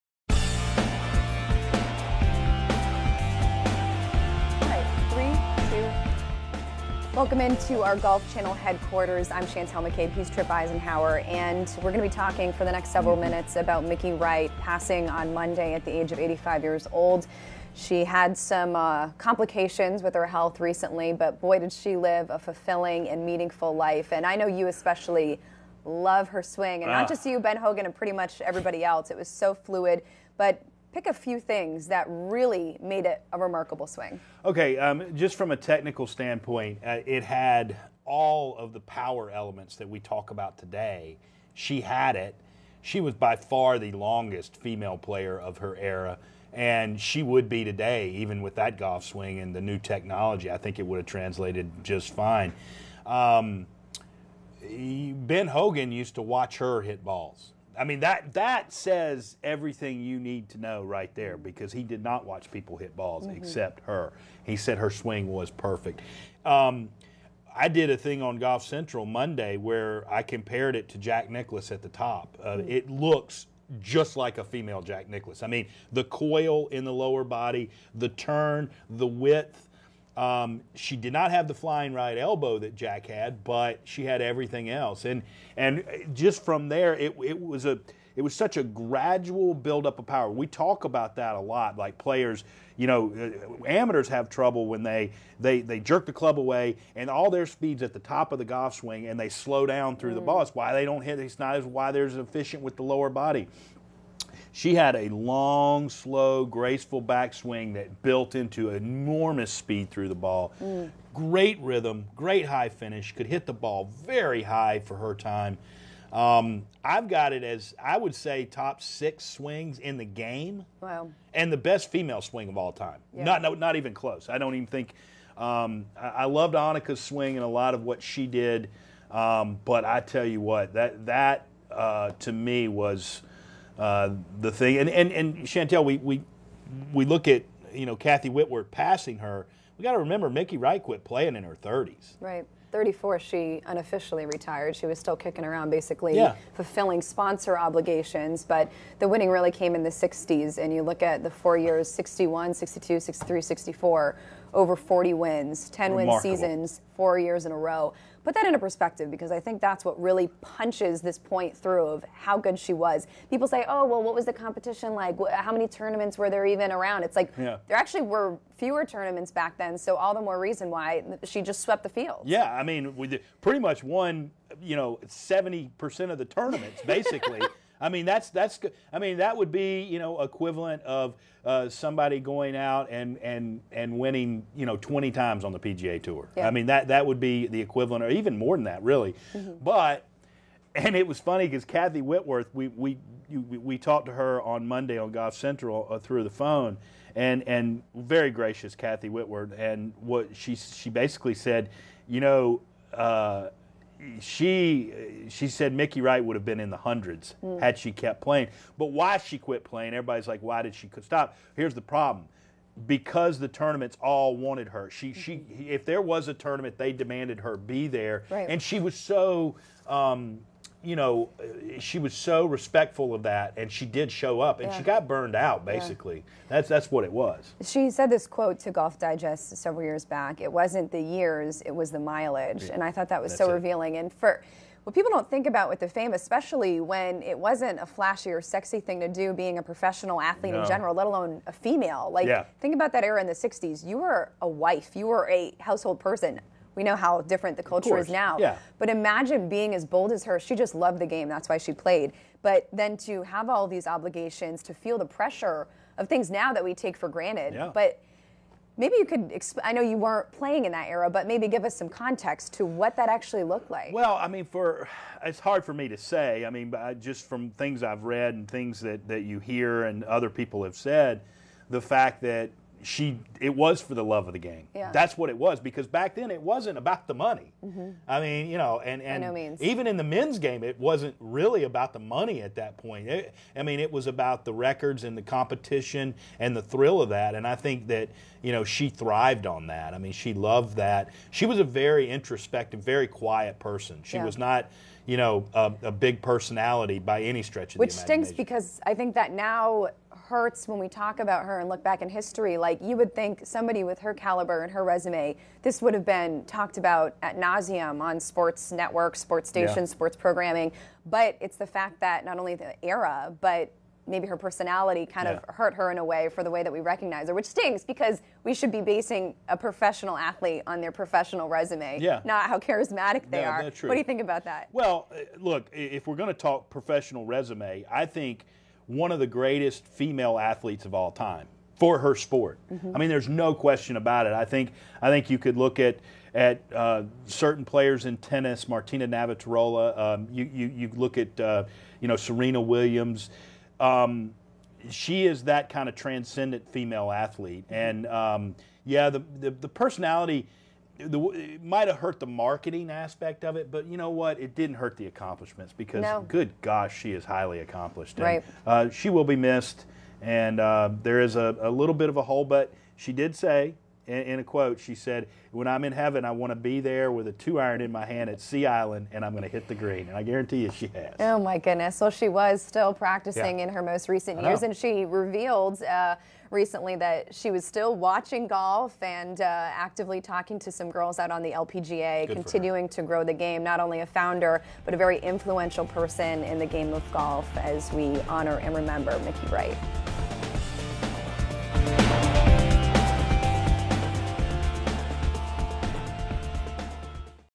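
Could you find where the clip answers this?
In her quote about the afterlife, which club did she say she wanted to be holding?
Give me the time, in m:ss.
6:07.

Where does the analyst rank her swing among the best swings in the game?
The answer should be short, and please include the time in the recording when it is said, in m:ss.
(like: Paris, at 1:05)
Top 6, at 1:58.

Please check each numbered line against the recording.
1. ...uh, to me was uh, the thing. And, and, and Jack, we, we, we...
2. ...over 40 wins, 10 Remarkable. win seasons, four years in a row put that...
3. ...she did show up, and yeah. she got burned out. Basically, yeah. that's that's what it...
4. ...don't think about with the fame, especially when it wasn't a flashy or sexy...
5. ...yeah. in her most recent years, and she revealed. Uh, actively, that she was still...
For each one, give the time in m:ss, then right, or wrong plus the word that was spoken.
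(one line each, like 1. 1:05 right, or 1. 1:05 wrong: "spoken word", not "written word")
1. 2:11 wrong: "Chantel", not "Jack"
2. 2:34 right
3. 3:43 right
4. 3:55 right
5. 6:13 wrong: "recently", not "actively".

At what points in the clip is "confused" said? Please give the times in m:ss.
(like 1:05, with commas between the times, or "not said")
not said.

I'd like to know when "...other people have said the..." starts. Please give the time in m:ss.
4:30.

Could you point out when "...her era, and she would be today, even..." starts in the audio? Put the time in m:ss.
0:45.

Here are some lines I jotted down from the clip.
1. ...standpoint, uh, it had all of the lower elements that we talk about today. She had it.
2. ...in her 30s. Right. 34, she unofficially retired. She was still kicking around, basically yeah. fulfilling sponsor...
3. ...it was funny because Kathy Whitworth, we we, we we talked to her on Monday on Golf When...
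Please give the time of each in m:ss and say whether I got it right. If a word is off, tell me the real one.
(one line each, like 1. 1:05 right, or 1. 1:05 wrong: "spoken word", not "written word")
1. 0:36 wrong: "power", not "lower"
2. 2:21 right
3. 3:10 wrong: "Central", not "When".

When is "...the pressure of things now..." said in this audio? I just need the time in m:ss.
4:14.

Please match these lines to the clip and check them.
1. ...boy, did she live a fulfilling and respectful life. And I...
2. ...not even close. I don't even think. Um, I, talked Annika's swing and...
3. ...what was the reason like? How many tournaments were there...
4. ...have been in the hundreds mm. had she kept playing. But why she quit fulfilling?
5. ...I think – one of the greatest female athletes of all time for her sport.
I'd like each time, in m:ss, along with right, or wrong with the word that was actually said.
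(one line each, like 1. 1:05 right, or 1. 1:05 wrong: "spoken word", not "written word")
1. 0:21 wrong: "meaningful", not "respectful"
2. 2:03 wrong: "loved", not "talked"
3. 2:44 wrong: "competition", not "reason"
4. 3:26 wrong: "playing", not "fulfilling"
5. 5:27 right.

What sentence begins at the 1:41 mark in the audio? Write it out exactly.
It's not as why they're as efficient with the lower body.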